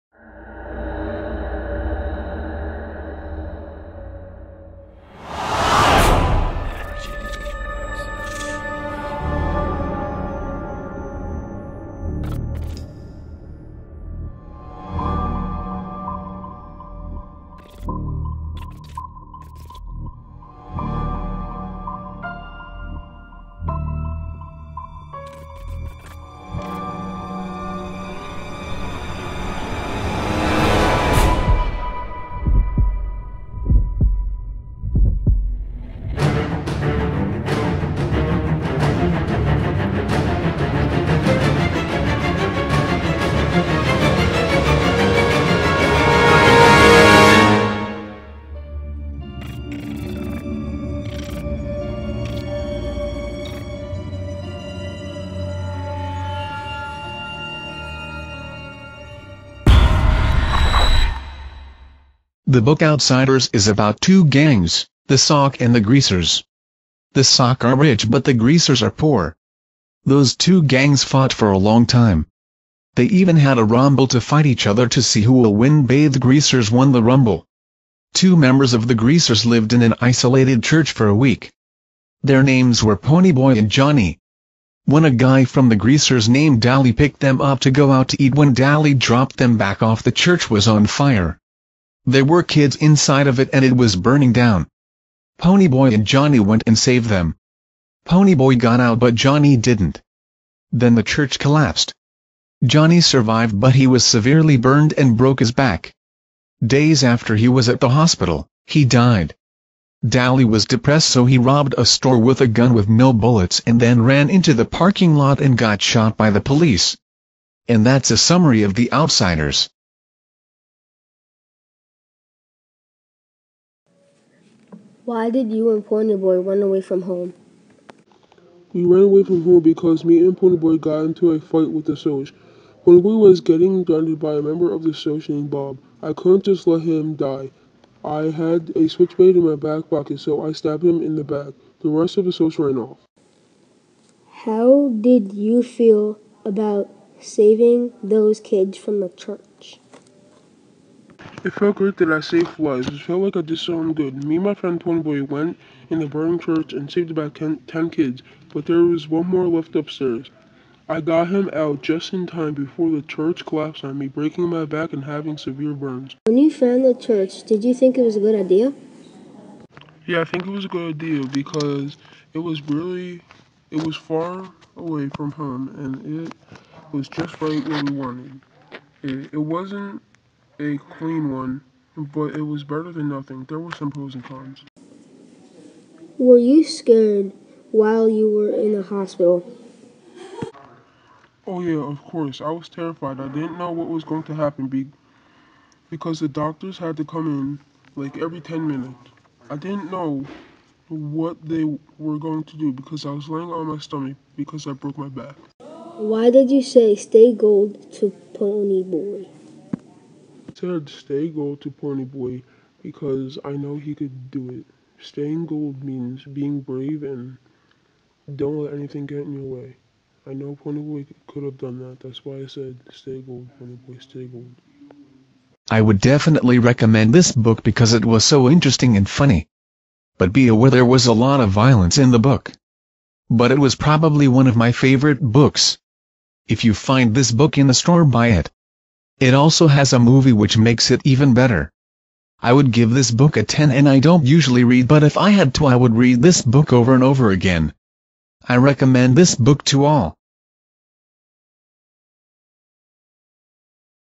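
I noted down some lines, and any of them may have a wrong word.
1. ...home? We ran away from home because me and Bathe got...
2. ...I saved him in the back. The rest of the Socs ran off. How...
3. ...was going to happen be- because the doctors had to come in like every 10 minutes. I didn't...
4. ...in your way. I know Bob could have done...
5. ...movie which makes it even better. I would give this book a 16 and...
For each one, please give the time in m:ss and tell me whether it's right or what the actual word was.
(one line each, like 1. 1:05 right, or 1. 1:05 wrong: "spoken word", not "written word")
1. 2:07 wrong: "Ponyboy", not "Bathe"
2. 2:20 wrong: "stabbed", not "saved"
3. 3:13 right
4. 3:39 wrong: "Ponyboy", not "Bob"
5. 3:59 wrong: "10", not "16".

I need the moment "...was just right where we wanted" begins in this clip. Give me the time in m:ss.
2:56.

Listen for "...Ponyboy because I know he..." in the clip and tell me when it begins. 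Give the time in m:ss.
3:31.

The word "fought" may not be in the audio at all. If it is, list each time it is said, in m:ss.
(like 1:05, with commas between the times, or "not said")
1:11.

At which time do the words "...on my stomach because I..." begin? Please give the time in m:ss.
3:23.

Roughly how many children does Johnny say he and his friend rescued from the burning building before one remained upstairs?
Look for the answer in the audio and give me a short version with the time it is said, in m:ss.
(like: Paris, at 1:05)
10, at 2:37.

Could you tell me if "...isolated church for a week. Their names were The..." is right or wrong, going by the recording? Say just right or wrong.
wrong.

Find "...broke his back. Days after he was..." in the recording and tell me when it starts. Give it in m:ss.
1:45.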